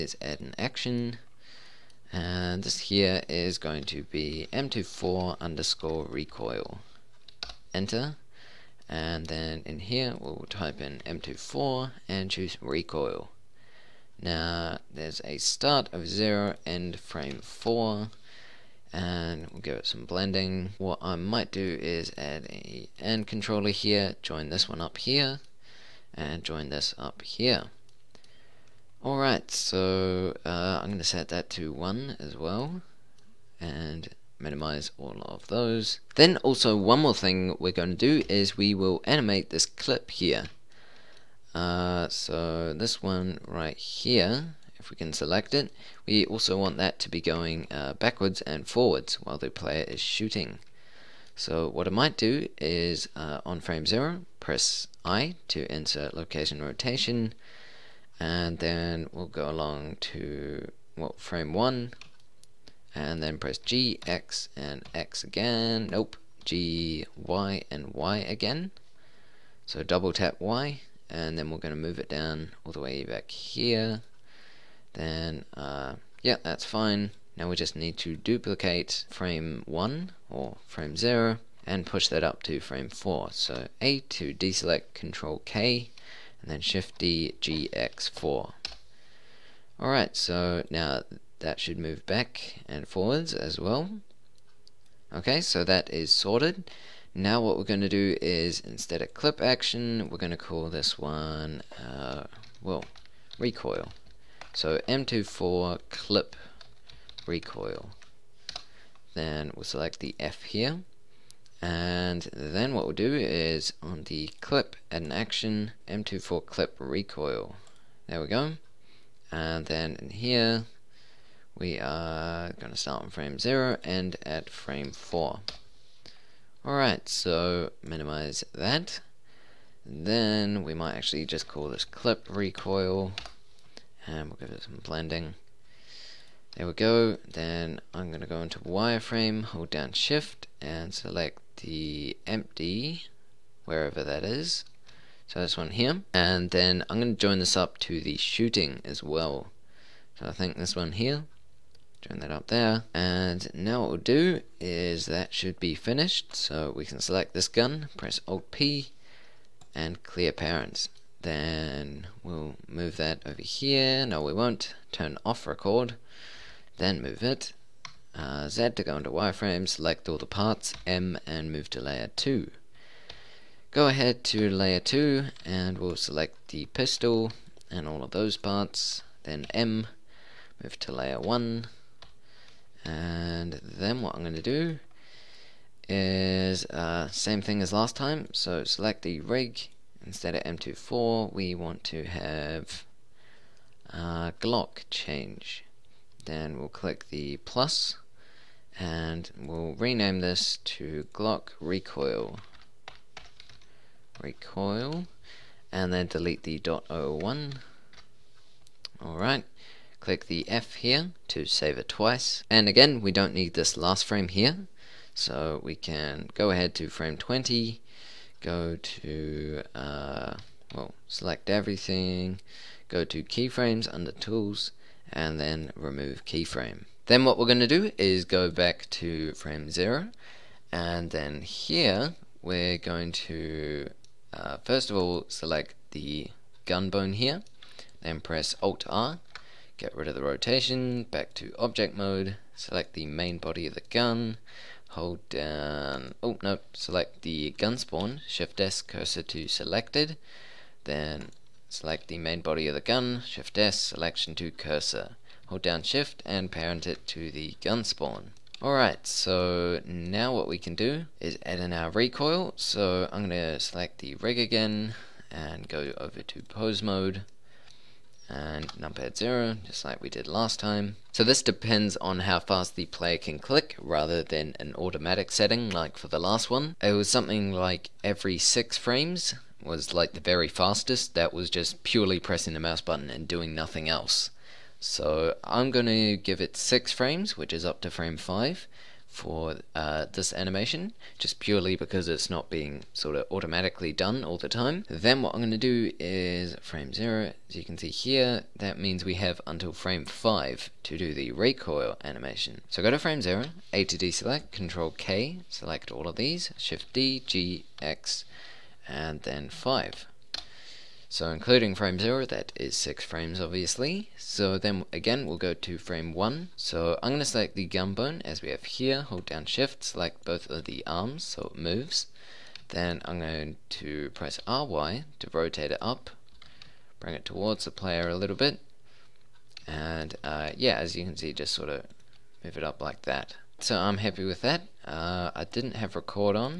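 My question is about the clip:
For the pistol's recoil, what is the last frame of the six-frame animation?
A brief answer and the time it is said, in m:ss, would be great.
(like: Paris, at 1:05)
Frame 5, at 4:47.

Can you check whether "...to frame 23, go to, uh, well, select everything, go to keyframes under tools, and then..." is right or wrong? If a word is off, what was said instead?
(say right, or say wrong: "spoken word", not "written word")
wrong: "20", not "23".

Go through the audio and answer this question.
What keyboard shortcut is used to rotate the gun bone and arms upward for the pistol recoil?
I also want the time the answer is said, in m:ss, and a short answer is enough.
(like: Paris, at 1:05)
RY, at 5:24.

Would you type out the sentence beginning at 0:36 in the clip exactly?
Then also one more thing we're going to do is we will animate this clip here.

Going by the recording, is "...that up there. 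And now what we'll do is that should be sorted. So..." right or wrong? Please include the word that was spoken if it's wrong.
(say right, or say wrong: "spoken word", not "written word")
wrong: "finished", not "sorted".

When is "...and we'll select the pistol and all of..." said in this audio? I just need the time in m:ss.
2:55.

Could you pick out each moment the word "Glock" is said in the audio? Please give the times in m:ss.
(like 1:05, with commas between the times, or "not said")
3:14, 3:21.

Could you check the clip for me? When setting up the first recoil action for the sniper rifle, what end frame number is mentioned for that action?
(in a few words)
4.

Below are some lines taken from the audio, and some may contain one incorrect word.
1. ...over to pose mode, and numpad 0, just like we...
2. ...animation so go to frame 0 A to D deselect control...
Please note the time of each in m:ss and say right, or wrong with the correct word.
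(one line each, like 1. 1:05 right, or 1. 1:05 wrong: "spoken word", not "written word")
1. 4:25 right
2. 5:02 wrong: "select", not "deselect".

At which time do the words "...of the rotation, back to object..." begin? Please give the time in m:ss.
4:00.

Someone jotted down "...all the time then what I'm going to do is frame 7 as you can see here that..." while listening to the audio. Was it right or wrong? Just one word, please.
wrong.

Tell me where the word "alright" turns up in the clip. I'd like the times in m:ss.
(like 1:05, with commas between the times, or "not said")
0:29, 1:29, 2:06, 3:29, 4:18.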